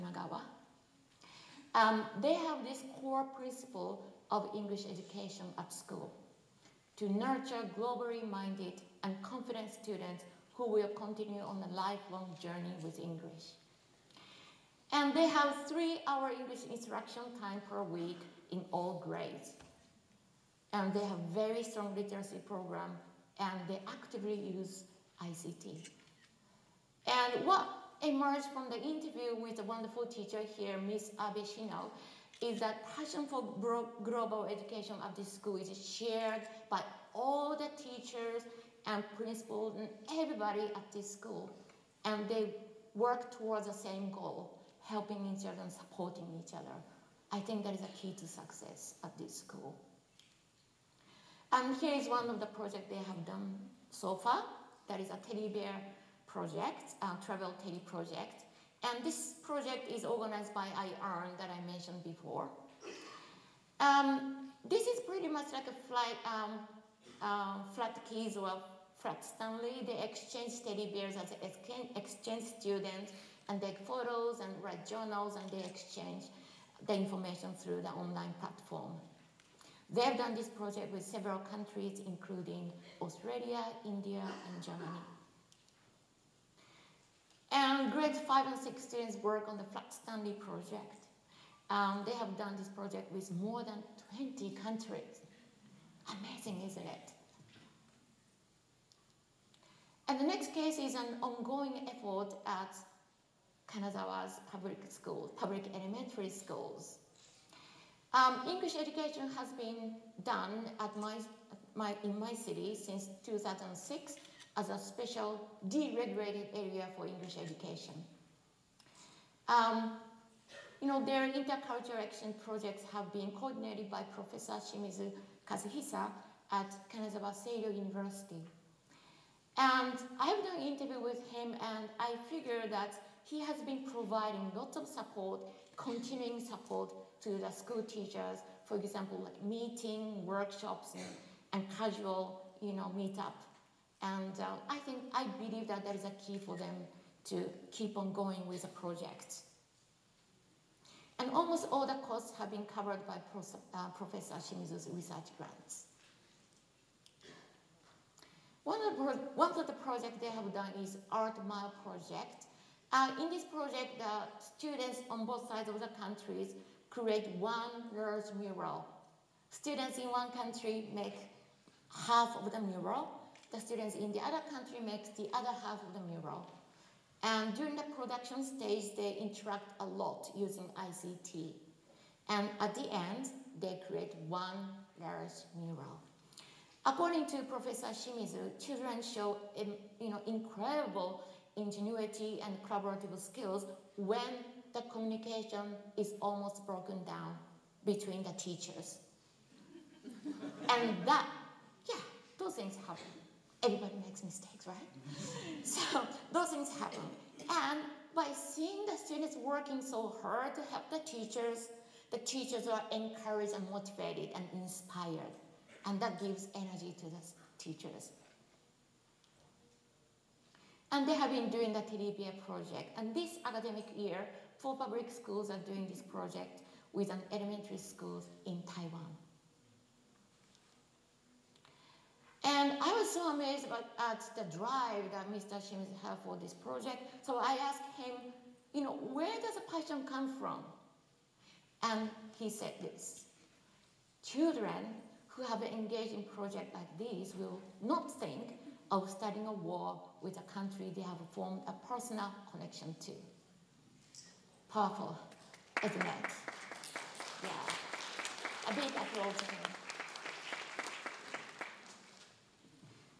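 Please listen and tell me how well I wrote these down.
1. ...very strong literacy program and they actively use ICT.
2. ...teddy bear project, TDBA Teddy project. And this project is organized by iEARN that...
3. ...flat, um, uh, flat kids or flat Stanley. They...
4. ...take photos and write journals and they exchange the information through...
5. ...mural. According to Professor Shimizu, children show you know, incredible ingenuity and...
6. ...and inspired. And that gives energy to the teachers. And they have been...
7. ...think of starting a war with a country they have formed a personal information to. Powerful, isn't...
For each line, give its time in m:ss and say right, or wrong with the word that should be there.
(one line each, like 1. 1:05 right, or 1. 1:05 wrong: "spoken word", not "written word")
1. 0:21 right
2. 0:55 wrong: "Travel", not "TDBA"
3. 1:05 right
4. 1:13 right
5. 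3:05 right
6. 3:34 right
7. 4:08 wrong: "connection", not "information".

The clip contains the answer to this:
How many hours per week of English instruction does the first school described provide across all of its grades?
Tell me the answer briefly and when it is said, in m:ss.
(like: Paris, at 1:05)
3, at 0:15.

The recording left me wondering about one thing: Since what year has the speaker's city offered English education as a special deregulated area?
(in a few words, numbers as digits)
2006.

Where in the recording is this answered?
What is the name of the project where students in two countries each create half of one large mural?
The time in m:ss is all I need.
2:41.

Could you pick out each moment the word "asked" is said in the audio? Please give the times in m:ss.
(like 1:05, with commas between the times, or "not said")
3:57.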